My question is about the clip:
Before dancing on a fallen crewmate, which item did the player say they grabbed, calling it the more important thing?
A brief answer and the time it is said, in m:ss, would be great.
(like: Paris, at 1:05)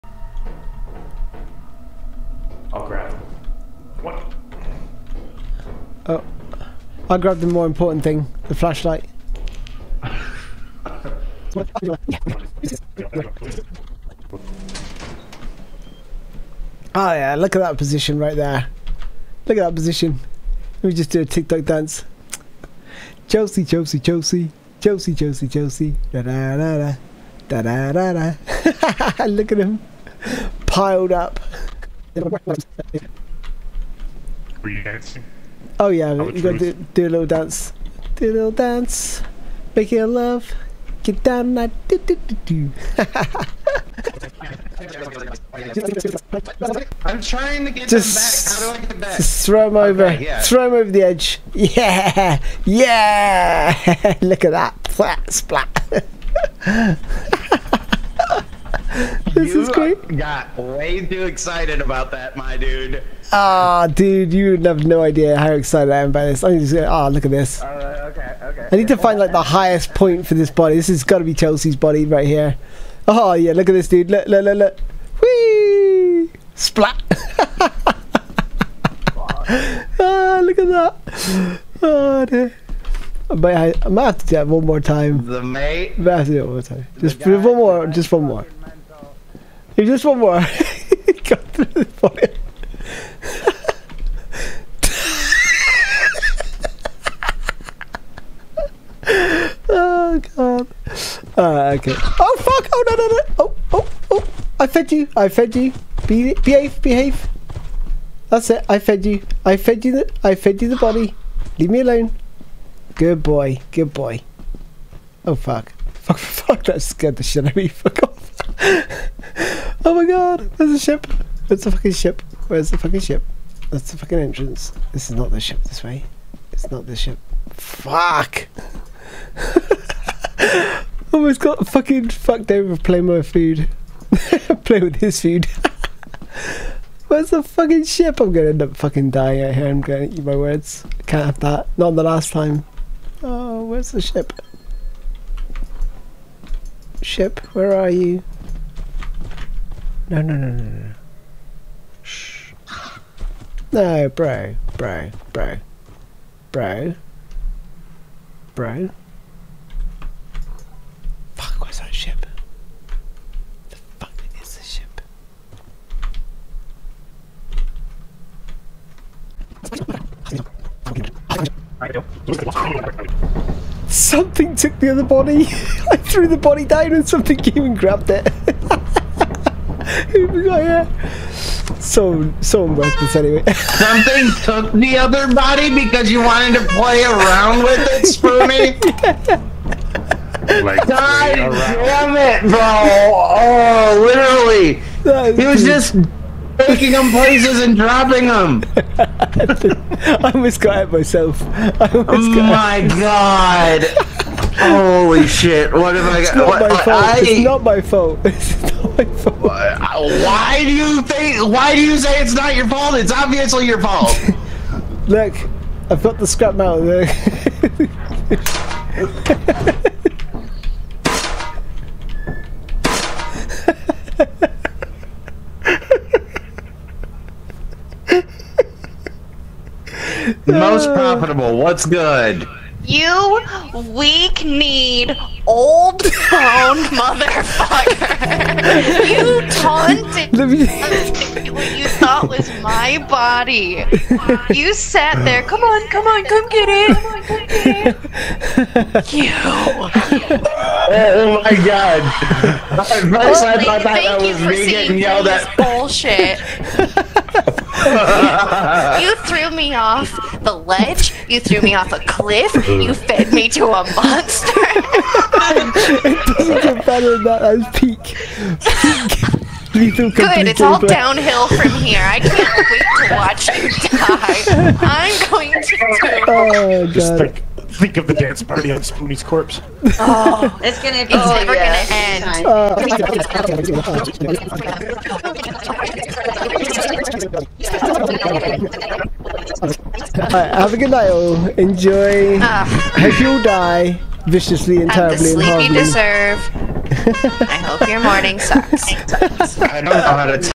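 The flashlight, at 0:08.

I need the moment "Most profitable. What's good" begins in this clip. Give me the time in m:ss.
3:50.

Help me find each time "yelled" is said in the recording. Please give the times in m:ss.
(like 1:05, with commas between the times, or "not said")
4:14.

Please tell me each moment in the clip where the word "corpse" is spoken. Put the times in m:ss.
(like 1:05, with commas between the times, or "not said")
4:39.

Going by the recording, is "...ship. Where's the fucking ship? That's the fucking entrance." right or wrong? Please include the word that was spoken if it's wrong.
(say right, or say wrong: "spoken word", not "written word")
right.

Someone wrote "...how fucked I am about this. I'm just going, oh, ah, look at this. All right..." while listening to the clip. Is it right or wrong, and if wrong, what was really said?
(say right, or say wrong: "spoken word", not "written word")
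wrong: "excited", not "fucked".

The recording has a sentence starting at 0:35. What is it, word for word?
Oh yeah, you gotta do, do, a little dance.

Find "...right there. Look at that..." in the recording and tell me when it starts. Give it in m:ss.
0:18.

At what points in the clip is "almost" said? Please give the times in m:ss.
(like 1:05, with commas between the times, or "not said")
2:11, 3:20.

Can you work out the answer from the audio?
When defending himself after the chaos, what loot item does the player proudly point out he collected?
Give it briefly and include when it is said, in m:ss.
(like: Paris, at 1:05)
Scrap metal, at 3:36.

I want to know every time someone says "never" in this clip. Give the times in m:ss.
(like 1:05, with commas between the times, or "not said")
4:41.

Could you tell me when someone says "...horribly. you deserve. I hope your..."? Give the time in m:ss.
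4:55.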